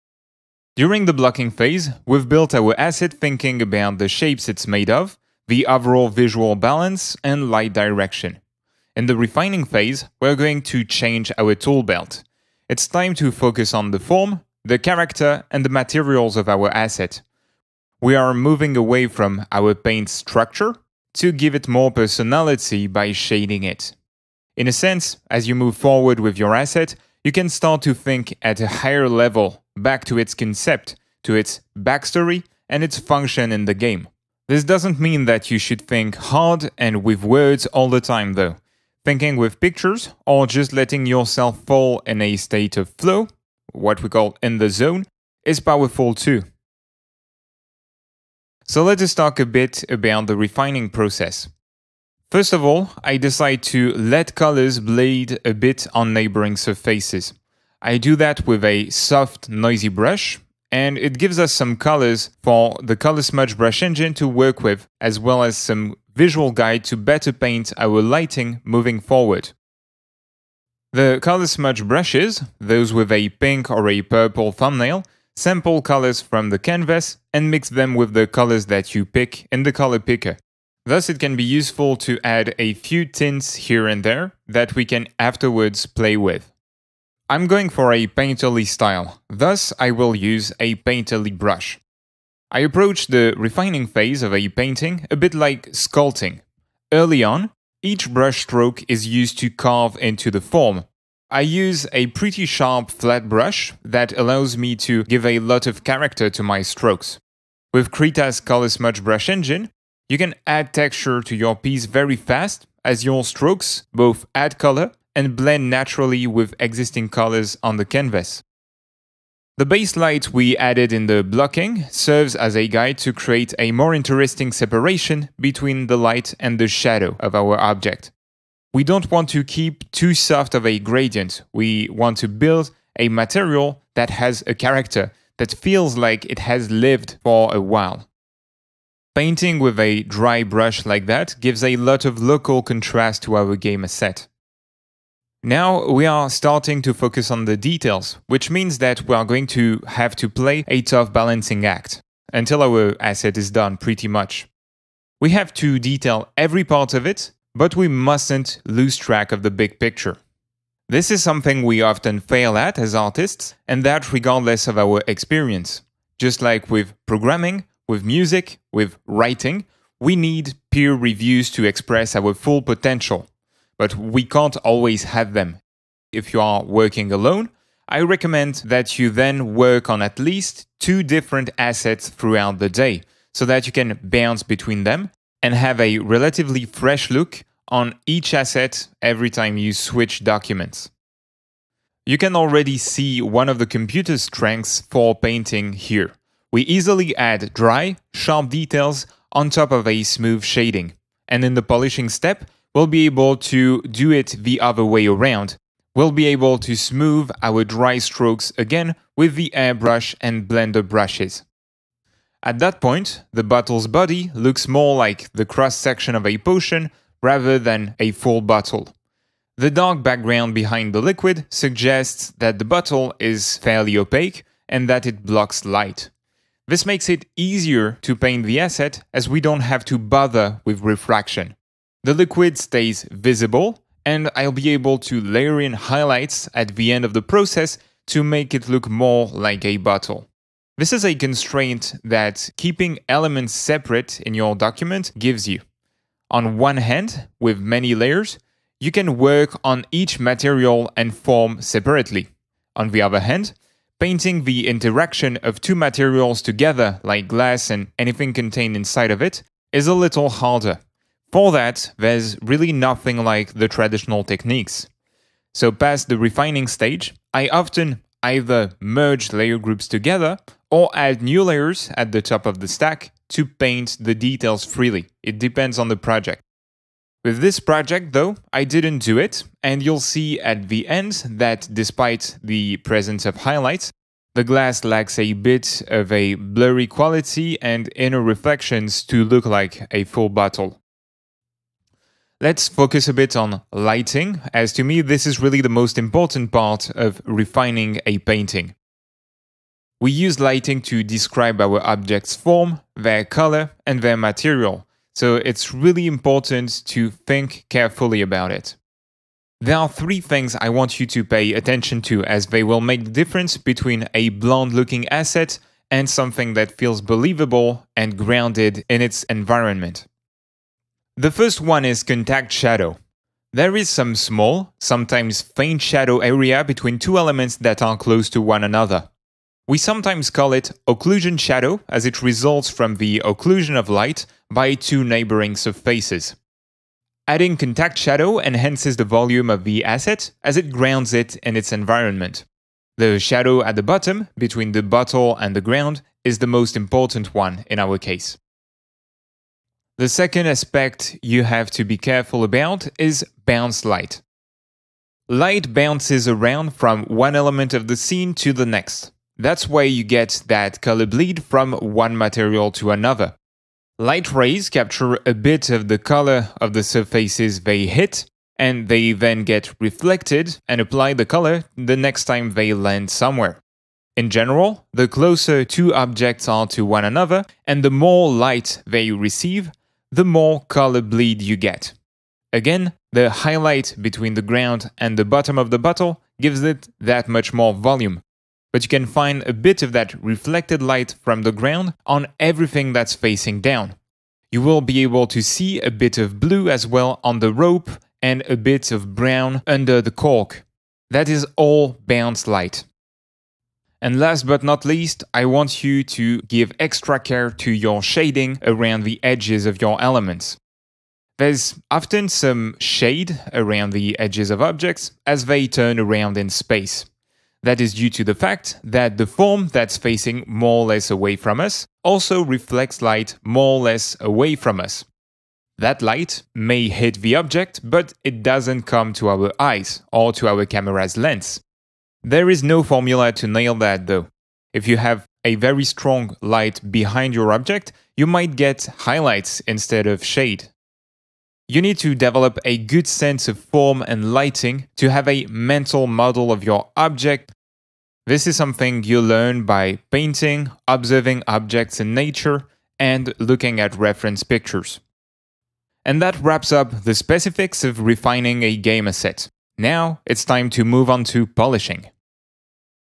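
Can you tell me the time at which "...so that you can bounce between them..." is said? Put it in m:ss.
3:03.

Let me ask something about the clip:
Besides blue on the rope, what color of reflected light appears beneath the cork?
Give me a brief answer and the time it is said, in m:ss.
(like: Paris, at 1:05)
brown, at 6:39.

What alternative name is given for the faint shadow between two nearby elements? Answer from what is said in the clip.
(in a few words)
occlusion shadow.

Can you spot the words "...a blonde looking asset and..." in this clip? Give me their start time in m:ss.
5:14.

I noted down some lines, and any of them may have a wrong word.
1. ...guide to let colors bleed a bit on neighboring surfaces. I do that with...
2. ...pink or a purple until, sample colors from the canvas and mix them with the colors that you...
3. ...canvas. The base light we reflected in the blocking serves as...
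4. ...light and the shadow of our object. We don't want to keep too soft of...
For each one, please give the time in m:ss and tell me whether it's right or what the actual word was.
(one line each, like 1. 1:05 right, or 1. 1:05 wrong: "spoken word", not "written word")
1. 0:53 wrong: "decide", not "guide"
2. 1:13 wrong: "thumbnail", not "until"
3. 1:57 wrong: "added", not "reflected"
4. 2:05 right.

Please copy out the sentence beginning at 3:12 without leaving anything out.
You can already see one of the computer's strengths for painting here.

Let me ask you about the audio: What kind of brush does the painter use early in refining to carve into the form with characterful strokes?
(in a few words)
sharp flat brush.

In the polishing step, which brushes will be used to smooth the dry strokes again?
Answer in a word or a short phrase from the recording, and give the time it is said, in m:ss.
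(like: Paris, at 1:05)
airbrush and blender, at 3:29.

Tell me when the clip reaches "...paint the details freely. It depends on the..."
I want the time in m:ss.
4:33.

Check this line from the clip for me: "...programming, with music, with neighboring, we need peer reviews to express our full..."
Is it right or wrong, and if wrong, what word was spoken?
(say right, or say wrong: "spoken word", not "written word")
wrong: "writing", not "neighboring".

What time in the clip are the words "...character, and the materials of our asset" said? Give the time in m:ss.
0:14.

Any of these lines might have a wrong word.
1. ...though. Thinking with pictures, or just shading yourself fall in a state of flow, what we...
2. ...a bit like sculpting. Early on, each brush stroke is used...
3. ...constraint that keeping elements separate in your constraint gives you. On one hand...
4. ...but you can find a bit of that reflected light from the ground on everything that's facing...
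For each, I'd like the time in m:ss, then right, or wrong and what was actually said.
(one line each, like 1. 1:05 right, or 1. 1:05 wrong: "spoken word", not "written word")
1. 0:38 wrong: "letting", not "shading"
2. 1:35 right
3. 4:01 wrong: "document", not "constraint"
4. 6:28 right.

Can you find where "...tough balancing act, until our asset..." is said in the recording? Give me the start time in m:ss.
2:30.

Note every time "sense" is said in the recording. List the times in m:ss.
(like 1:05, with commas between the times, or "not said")
0:24, 7:23.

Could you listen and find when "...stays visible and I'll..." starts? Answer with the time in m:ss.
3:52.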